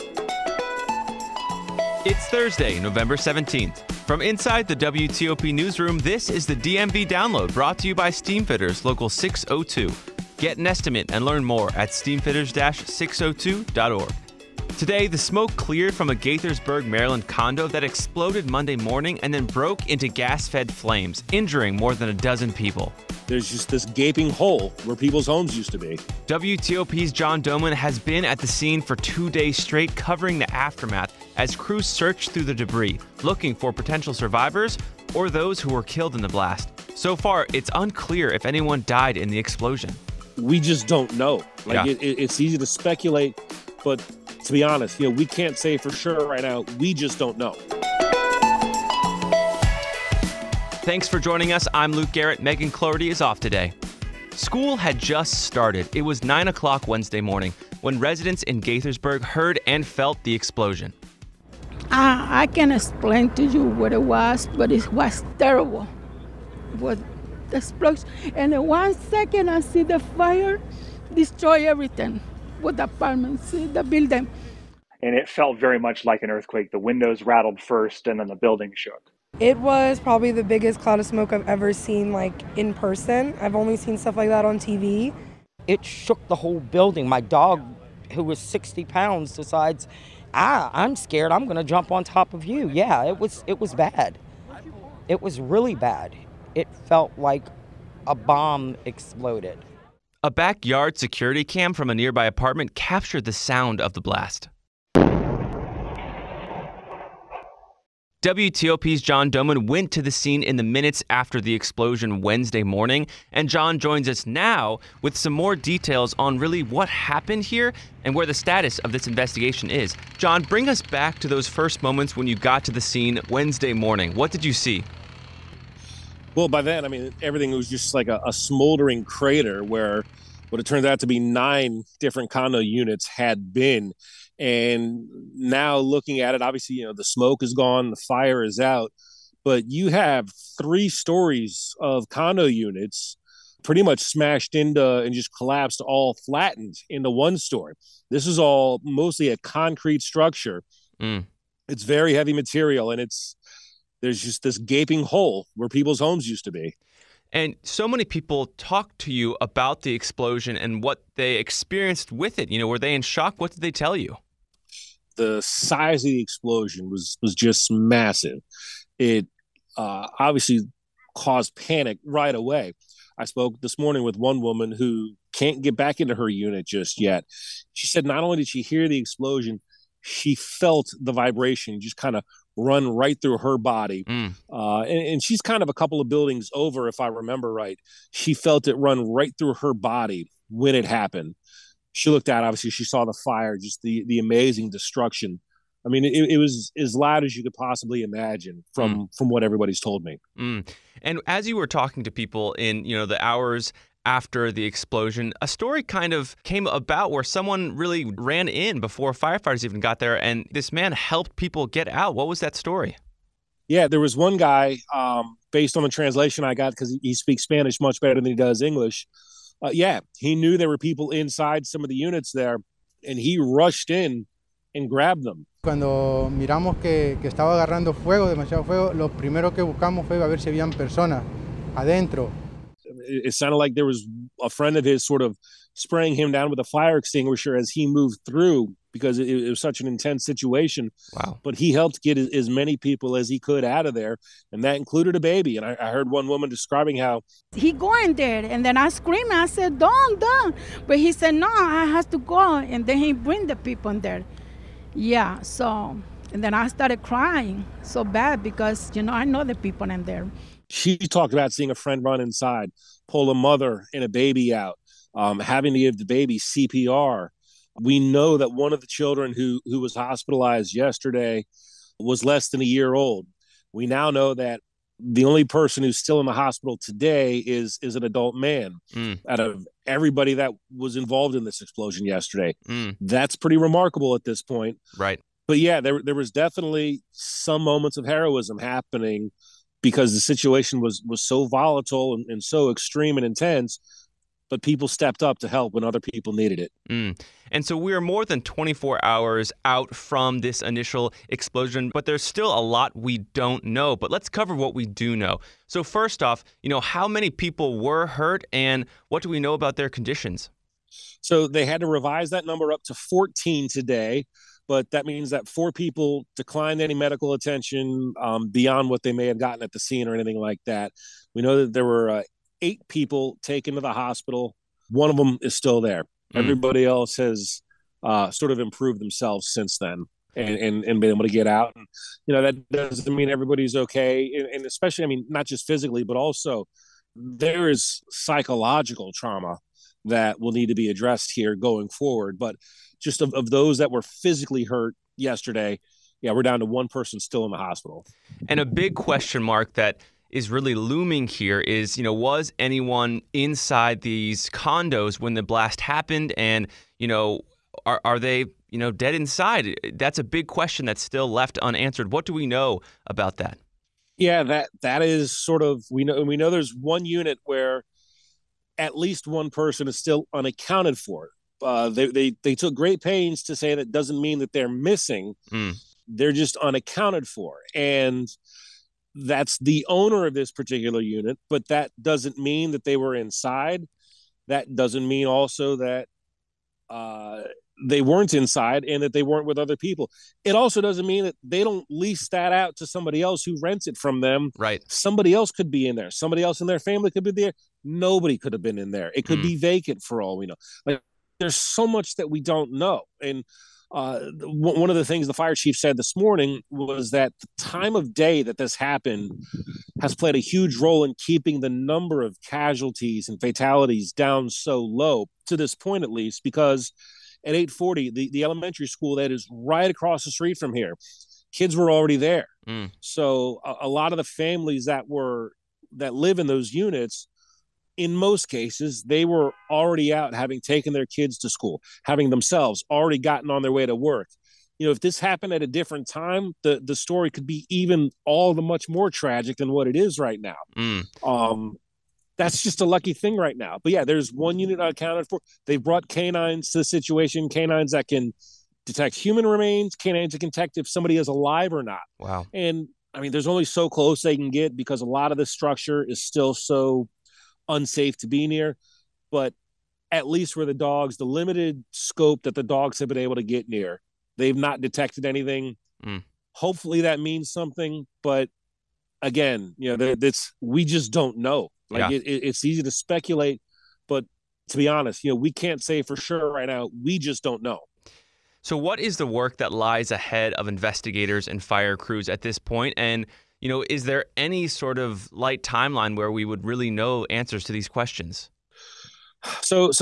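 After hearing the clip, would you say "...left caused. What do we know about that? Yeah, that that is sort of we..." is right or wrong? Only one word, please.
wrong.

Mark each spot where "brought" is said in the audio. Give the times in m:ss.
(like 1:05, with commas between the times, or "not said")
0:07, 7:25.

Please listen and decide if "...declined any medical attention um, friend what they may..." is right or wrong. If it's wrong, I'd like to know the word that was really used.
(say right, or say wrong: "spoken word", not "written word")
wrong: "beyond", not "friend".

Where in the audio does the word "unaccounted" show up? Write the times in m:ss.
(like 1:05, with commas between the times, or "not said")
6:10, 6:16.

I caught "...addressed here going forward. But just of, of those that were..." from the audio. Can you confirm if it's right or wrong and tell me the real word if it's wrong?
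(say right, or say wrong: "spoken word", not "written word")
right.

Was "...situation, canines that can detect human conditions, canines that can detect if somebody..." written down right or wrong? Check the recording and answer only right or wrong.
wrong.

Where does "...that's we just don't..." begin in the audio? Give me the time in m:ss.
7:50.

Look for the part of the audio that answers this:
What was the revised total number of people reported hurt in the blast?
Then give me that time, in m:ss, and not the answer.
5:12.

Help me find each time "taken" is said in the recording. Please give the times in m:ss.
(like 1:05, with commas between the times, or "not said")
5:23, 7:10.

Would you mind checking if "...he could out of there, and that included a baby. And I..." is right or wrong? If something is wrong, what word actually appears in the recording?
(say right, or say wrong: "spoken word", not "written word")
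right.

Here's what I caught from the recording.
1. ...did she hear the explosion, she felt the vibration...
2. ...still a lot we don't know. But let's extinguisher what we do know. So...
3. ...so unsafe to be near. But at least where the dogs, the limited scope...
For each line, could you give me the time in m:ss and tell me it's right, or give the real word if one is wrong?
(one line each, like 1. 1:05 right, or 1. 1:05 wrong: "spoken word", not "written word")
1. 2:58 right
2. 5:02 wrong: "cover", not "extinguisher"
3. 7:36 right.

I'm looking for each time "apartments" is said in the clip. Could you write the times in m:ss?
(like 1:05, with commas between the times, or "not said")
1:12, 1:42.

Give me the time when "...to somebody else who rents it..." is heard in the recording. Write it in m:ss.
6:32.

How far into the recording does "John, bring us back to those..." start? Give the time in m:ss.
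2:00.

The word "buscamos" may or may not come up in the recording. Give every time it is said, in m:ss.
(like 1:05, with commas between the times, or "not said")
3:49.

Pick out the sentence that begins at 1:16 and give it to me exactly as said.
The windows rattled first and then the building shook.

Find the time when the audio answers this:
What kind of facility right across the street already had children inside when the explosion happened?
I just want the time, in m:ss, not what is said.
6:58.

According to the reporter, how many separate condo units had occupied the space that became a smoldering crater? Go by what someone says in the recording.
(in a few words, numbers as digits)
9.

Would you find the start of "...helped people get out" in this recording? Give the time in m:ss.
3:30.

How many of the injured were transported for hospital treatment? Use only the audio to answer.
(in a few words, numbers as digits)
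8.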